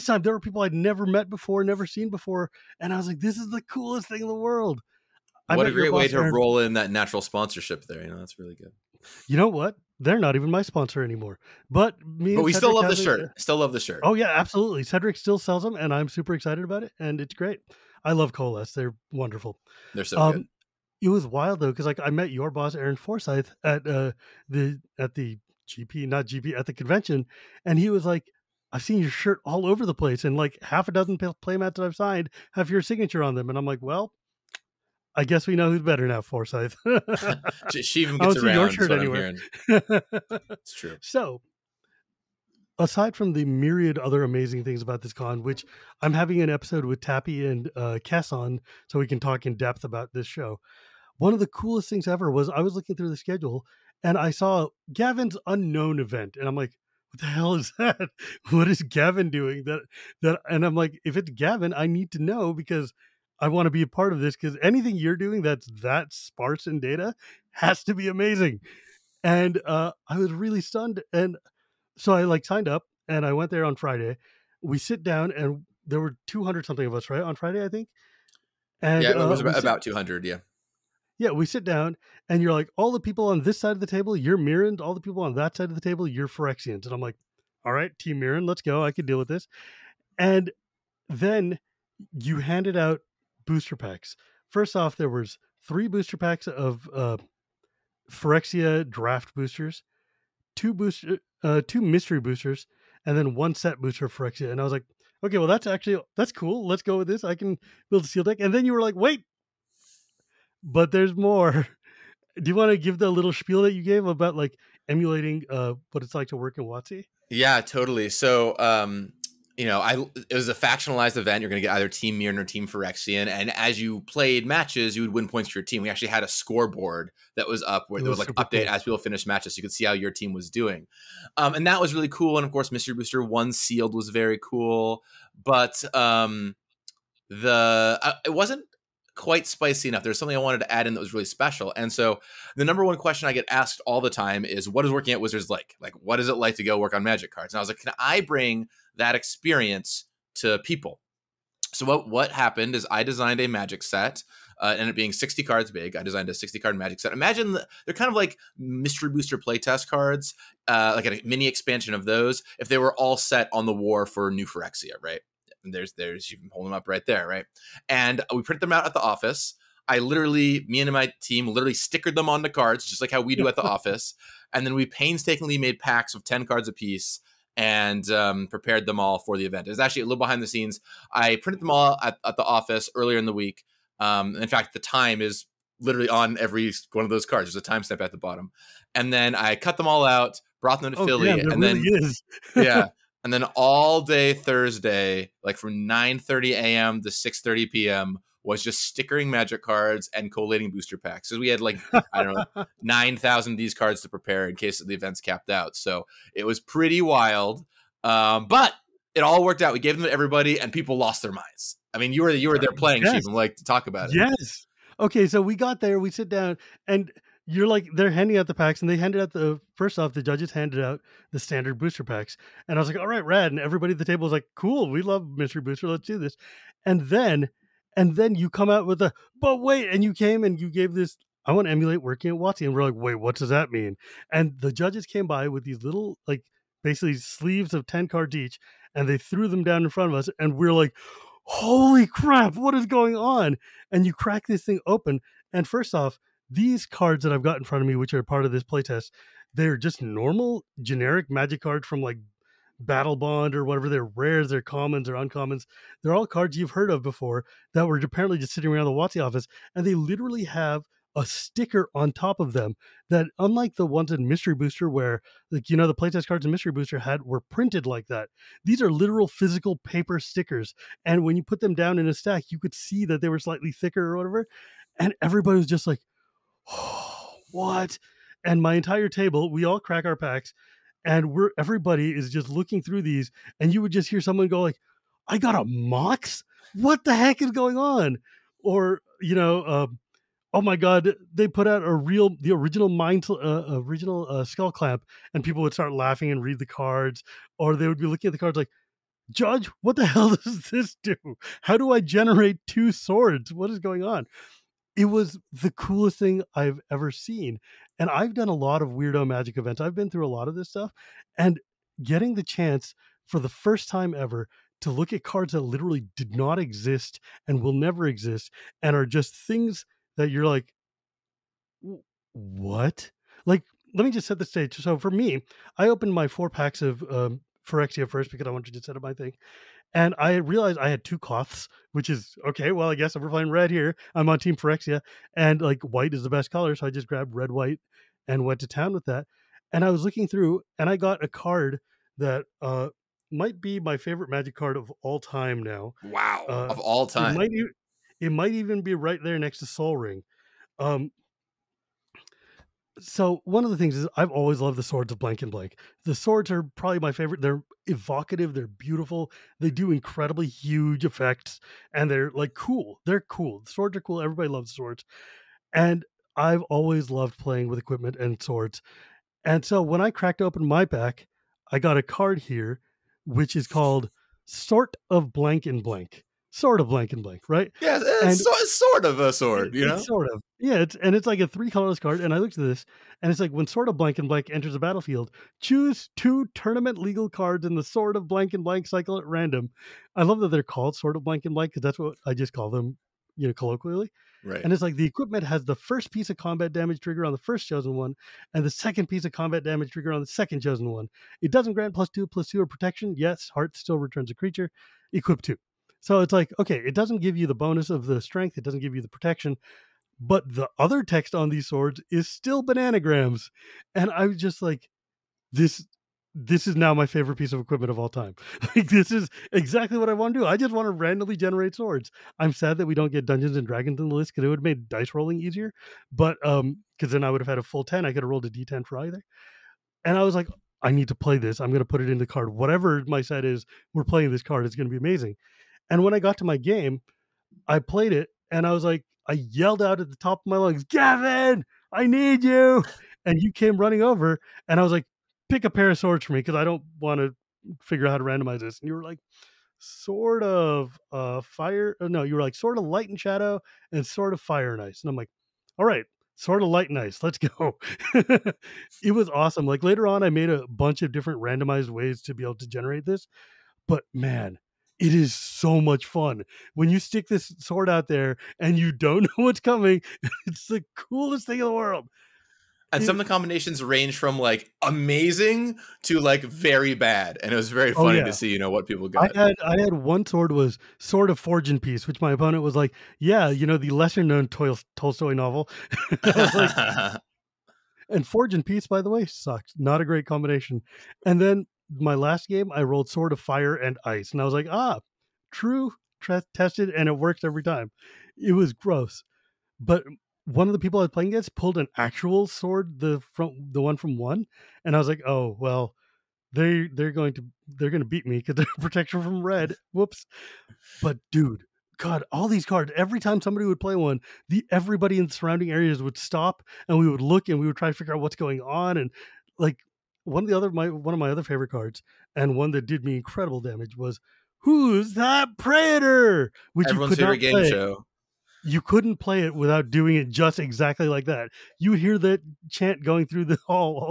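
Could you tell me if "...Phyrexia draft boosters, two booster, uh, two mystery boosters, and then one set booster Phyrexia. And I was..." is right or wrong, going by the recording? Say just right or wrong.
right.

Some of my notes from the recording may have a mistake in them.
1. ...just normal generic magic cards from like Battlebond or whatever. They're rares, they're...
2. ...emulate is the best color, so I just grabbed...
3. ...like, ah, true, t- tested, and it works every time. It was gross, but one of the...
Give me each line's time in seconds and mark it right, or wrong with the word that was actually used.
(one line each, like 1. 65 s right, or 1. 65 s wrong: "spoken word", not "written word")
1. 249 s right
2. 335 s wrong: "white", not "emulate"
3. 494 s right.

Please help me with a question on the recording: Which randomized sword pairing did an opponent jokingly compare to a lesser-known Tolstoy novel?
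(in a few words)
Forge and Peace.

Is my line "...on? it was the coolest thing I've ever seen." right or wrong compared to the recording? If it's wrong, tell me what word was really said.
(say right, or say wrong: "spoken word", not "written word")
right.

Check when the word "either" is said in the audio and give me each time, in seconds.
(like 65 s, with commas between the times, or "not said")
121 s, 428 s.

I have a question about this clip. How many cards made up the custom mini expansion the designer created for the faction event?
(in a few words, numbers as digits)
60.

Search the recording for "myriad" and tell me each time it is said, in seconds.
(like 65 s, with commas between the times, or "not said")
43 s.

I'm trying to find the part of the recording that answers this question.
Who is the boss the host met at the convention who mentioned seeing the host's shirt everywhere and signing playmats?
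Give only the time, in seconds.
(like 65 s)
22 s.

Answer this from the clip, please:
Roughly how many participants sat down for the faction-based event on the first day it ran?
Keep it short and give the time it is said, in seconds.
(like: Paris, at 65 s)
200, at 76 s.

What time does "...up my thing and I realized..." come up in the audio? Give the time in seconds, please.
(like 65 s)
328 s.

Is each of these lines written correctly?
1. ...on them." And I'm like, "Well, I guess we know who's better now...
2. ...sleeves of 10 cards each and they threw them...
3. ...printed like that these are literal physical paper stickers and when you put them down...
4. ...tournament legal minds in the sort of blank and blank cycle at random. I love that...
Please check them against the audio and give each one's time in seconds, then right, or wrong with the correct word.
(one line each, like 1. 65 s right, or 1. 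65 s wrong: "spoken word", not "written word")
1. 33 s right
2. 237 s right
3. 267 s right
4. 386 s wrong: "cards", not "minds".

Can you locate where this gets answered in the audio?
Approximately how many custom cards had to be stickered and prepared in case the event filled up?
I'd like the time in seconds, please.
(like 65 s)
202 s.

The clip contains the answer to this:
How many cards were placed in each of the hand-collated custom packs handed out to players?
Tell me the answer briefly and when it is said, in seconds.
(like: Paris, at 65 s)
10, at 176 s.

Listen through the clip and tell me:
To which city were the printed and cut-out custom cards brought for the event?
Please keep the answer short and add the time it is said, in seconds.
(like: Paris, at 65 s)
Philly, at 191 s.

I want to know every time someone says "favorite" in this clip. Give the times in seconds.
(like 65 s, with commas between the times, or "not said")
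343 s, 357 s, 417 s, 521 s, 527 s.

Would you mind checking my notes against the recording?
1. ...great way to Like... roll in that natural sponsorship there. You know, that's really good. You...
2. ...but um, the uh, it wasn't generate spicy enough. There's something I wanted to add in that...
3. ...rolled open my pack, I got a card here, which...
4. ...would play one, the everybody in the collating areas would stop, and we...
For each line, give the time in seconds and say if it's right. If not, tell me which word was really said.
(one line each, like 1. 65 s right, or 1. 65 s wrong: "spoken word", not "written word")
1. 5 s wrong: "Aaron", not "Like"
2. 135 s wrong: "quite", not "generate"
3. 370 s wrong: "cracked", not "rolled"
4. 513 s wrong: "surrounding", not "collating".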